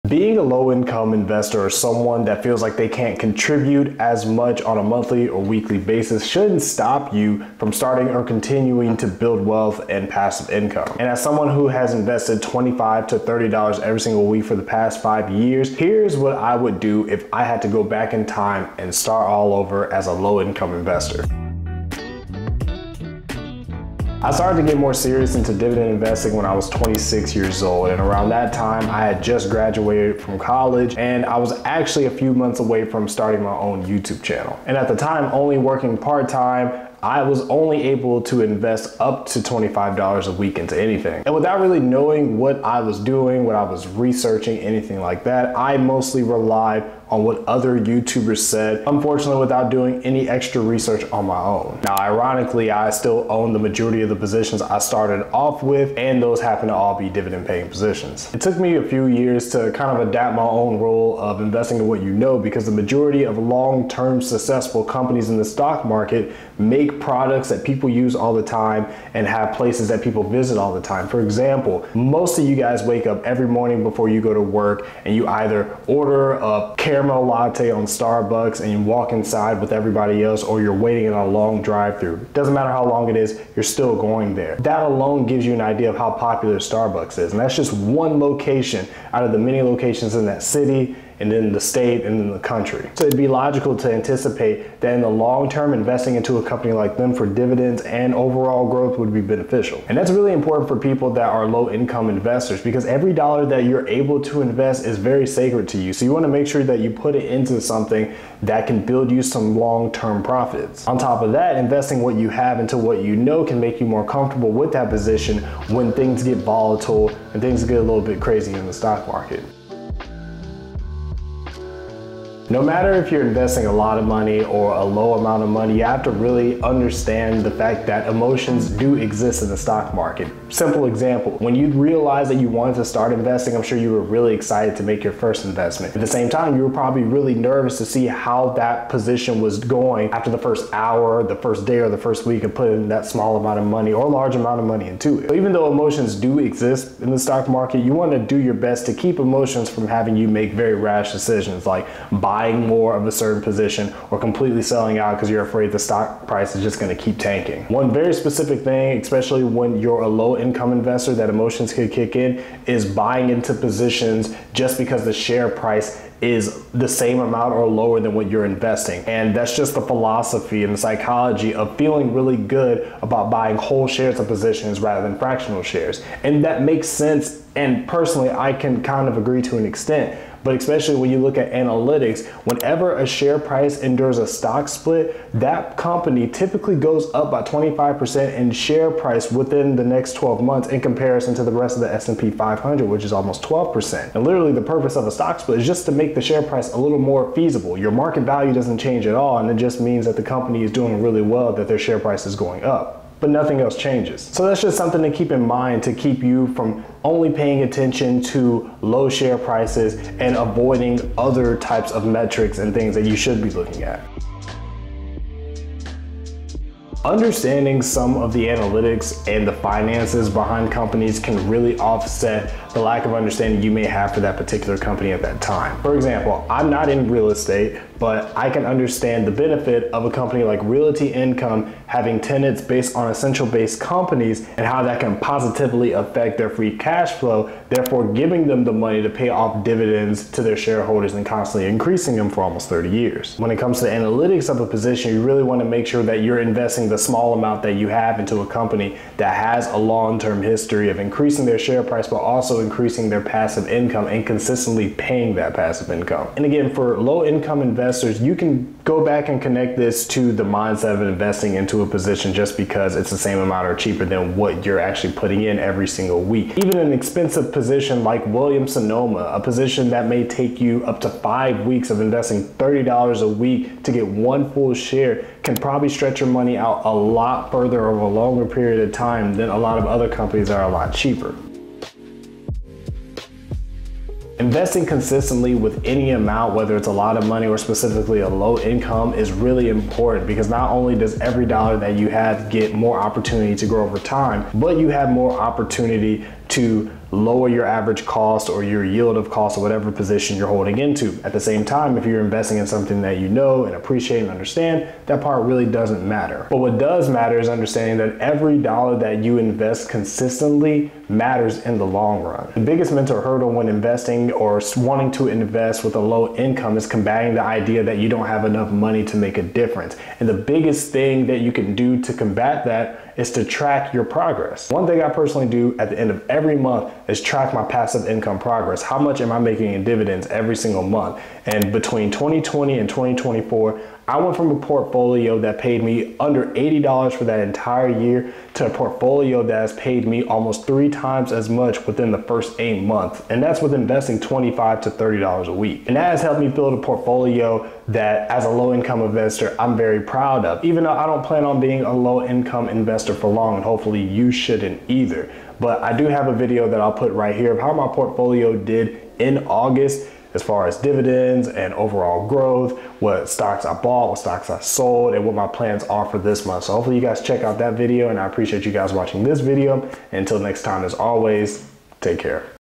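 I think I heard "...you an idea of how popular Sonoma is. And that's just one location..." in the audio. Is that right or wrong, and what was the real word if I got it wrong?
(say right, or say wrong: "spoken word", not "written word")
wrong: "Starbucks", not "Sonoma".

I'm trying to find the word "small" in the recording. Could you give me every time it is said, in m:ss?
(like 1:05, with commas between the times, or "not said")
2:23, 4:06.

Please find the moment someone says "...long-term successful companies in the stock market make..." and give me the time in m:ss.
1:03.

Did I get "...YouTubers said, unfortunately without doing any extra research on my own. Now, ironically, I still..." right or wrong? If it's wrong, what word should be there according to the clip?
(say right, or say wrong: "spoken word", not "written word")
right.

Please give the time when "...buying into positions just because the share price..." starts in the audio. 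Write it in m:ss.
2:42.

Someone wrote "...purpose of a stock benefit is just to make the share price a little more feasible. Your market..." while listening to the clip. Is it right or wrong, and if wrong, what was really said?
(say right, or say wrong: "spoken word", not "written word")
wrong: "split", not "benefit".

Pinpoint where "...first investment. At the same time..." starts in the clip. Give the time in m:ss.
2:15.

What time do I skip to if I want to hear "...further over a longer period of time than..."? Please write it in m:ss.
4:37.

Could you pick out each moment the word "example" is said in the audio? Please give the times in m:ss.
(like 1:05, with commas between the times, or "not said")
1:11, 2:10, 3:45.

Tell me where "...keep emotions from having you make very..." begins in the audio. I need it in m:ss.
2:28.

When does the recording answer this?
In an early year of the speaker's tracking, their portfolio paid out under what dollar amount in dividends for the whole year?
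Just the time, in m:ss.
5:36.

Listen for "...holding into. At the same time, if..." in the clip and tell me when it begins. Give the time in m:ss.
5:00.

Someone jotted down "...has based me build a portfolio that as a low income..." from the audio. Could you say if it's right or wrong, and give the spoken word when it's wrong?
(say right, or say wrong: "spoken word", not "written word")
wrong: "helped", not "based".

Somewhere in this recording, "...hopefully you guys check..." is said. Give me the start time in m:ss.
6:06.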